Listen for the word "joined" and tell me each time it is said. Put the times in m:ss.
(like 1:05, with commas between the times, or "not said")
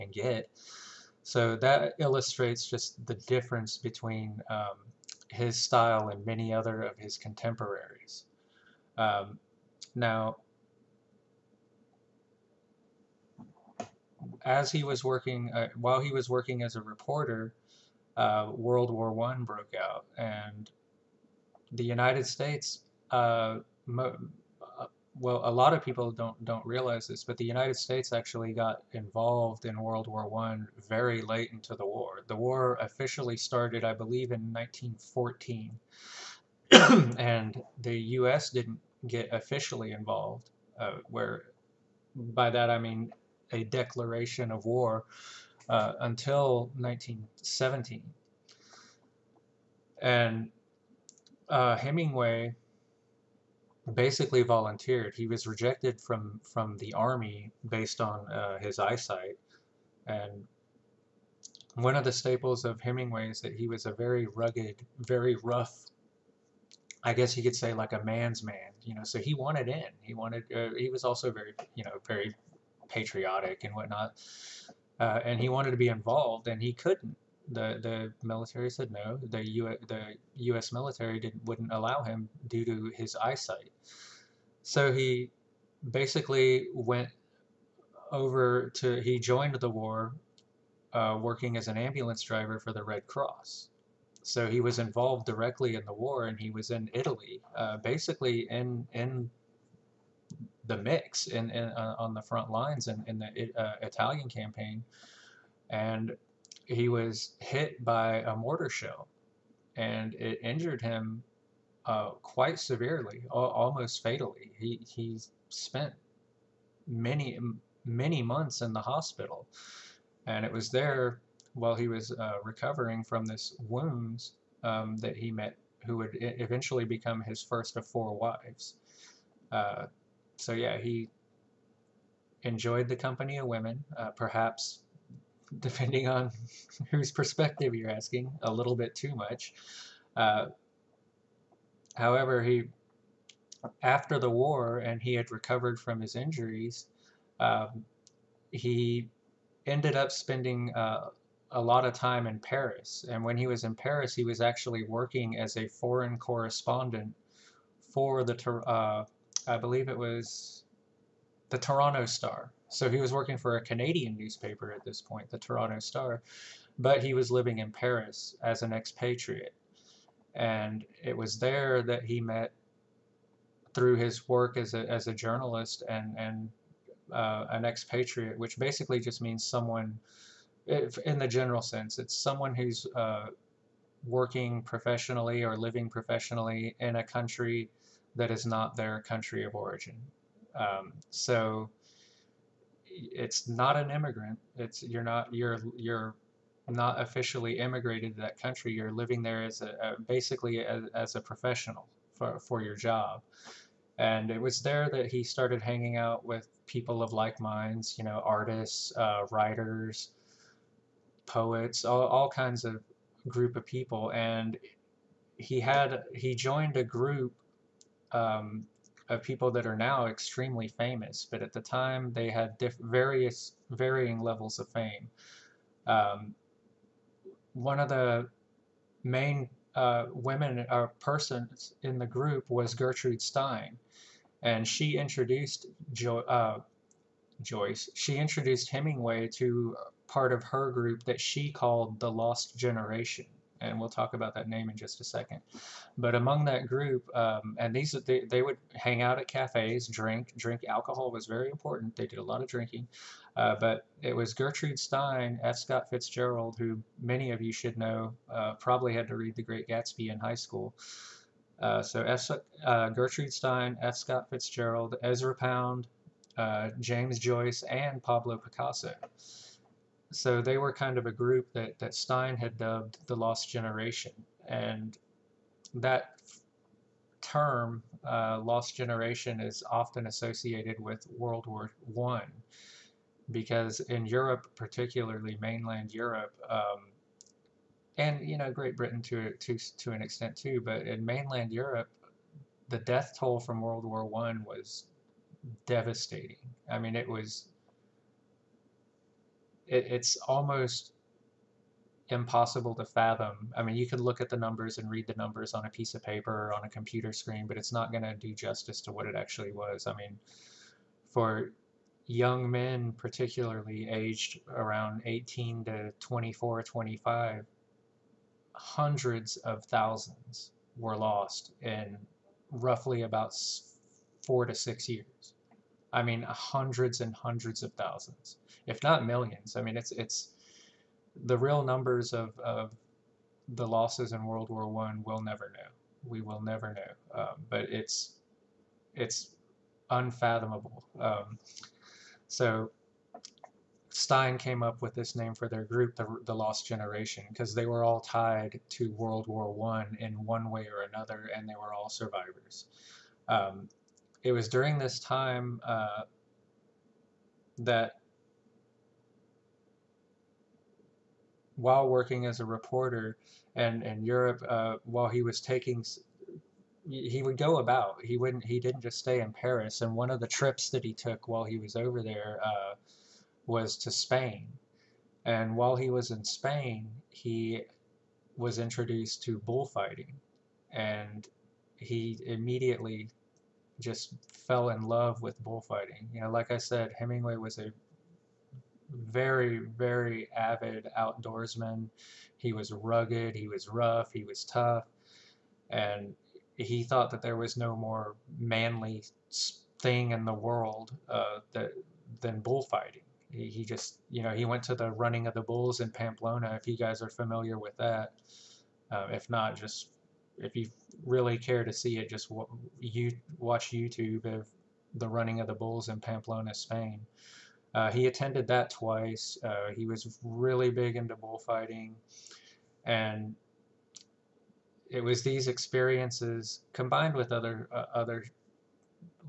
1:29, 3:36.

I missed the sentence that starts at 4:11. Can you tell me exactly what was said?
They did a lot of drinking, uh, but it was Gertrude Stein, F.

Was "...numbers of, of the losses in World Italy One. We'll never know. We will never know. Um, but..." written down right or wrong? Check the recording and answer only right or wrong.
wrong.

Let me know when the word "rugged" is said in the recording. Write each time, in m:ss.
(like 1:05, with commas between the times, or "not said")
1:04, 6:32.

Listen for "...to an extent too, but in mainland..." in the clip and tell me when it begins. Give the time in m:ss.
4:49.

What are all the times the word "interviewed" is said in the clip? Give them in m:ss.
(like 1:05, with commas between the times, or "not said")
not said.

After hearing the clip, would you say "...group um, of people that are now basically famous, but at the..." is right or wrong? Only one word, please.
wrong.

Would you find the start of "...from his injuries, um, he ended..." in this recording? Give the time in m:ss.
2:25.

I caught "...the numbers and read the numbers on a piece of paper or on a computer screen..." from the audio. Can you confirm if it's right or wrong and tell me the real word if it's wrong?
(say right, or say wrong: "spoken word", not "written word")
right.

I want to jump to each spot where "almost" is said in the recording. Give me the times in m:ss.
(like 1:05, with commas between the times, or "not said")
1:53, 5:00.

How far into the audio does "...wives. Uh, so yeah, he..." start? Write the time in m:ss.
2:08.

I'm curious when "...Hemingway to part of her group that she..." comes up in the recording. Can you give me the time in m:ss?
3:58.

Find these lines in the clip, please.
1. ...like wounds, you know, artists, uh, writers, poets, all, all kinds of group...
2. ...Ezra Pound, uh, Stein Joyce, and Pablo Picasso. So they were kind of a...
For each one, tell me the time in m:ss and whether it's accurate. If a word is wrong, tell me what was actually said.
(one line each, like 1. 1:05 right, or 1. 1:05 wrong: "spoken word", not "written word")
1. 3:27 wrong: "minds", not "wounds"
2. 4:25 wrong: "James", not "Stein".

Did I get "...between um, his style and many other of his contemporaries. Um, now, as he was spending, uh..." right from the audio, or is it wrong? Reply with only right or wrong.
wrong.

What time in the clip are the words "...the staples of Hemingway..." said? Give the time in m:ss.
1:02.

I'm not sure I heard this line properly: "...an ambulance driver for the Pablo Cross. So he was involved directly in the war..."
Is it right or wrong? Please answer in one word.
wrong.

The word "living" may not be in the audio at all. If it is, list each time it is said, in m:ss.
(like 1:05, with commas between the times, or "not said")
2:47, 3:05, 3:18.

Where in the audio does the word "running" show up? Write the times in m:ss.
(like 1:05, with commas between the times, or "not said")
6:44, 6:55.